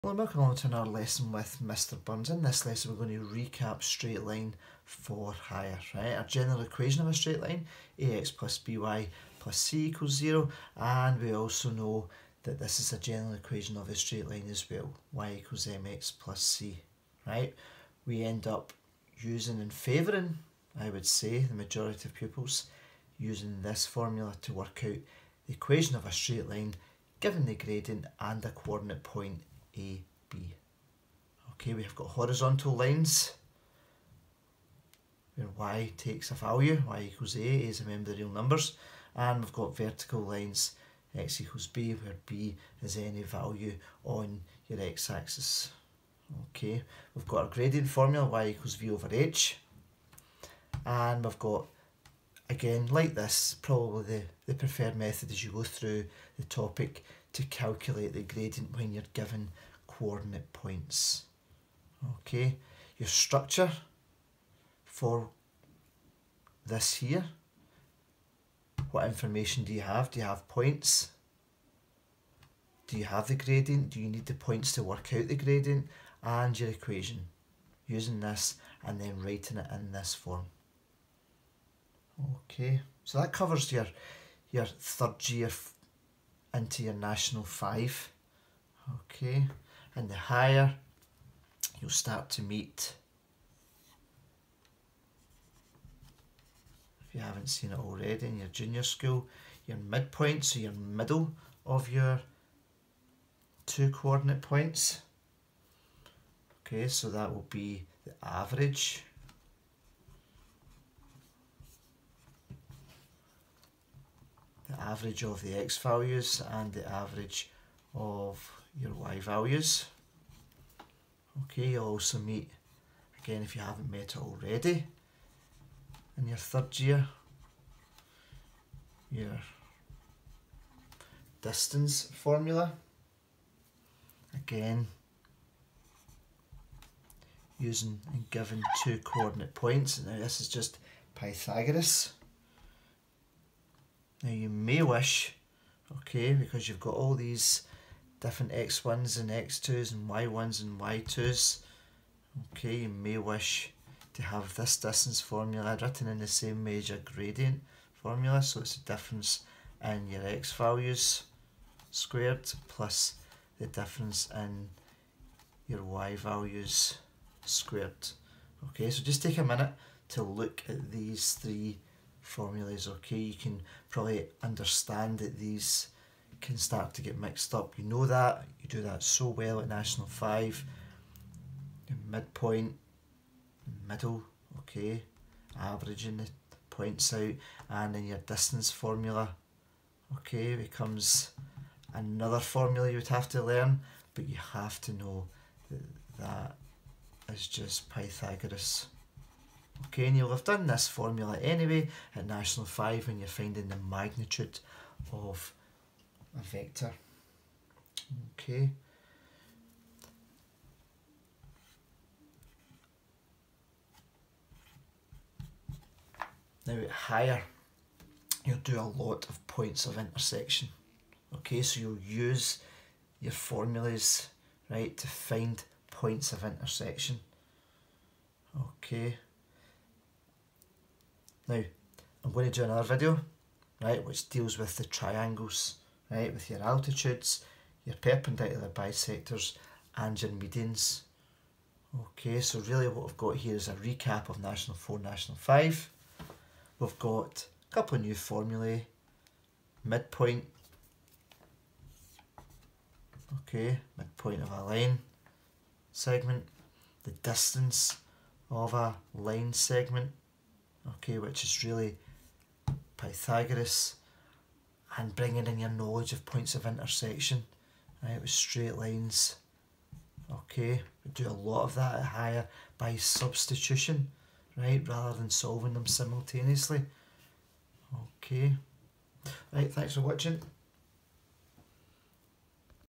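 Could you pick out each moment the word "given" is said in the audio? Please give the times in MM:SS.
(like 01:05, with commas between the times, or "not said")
00:27, 00:59, 02:18.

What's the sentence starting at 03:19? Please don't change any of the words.
Okay, you'll have done this formula anyway at National 5 when you're finding the magnitude of a vector.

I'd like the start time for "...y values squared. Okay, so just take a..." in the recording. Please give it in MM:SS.
02:45.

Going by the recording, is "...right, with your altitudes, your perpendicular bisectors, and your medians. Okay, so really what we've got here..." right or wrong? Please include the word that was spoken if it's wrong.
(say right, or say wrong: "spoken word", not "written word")
right.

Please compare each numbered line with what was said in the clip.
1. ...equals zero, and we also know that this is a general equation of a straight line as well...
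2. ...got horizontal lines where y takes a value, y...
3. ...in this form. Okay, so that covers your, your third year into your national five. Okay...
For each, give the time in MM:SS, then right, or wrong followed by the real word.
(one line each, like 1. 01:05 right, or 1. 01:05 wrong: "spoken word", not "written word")
1. 00:09 right
2. 00:31 right
3. 01:19 right.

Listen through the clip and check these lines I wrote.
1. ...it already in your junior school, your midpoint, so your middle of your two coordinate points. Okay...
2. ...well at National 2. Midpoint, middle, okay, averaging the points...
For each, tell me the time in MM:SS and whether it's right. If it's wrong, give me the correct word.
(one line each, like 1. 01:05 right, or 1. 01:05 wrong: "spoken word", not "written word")
1. 01:37 right
2. 02:59 wrong: "5", not "2".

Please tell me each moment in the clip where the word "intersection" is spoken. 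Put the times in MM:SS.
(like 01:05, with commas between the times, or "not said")
03:39, 03:46, 04:26.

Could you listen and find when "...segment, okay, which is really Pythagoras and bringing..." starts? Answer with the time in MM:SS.
04:19.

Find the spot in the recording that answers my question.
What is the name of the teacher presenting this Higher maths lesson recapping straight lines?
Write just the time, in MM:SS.
00:01.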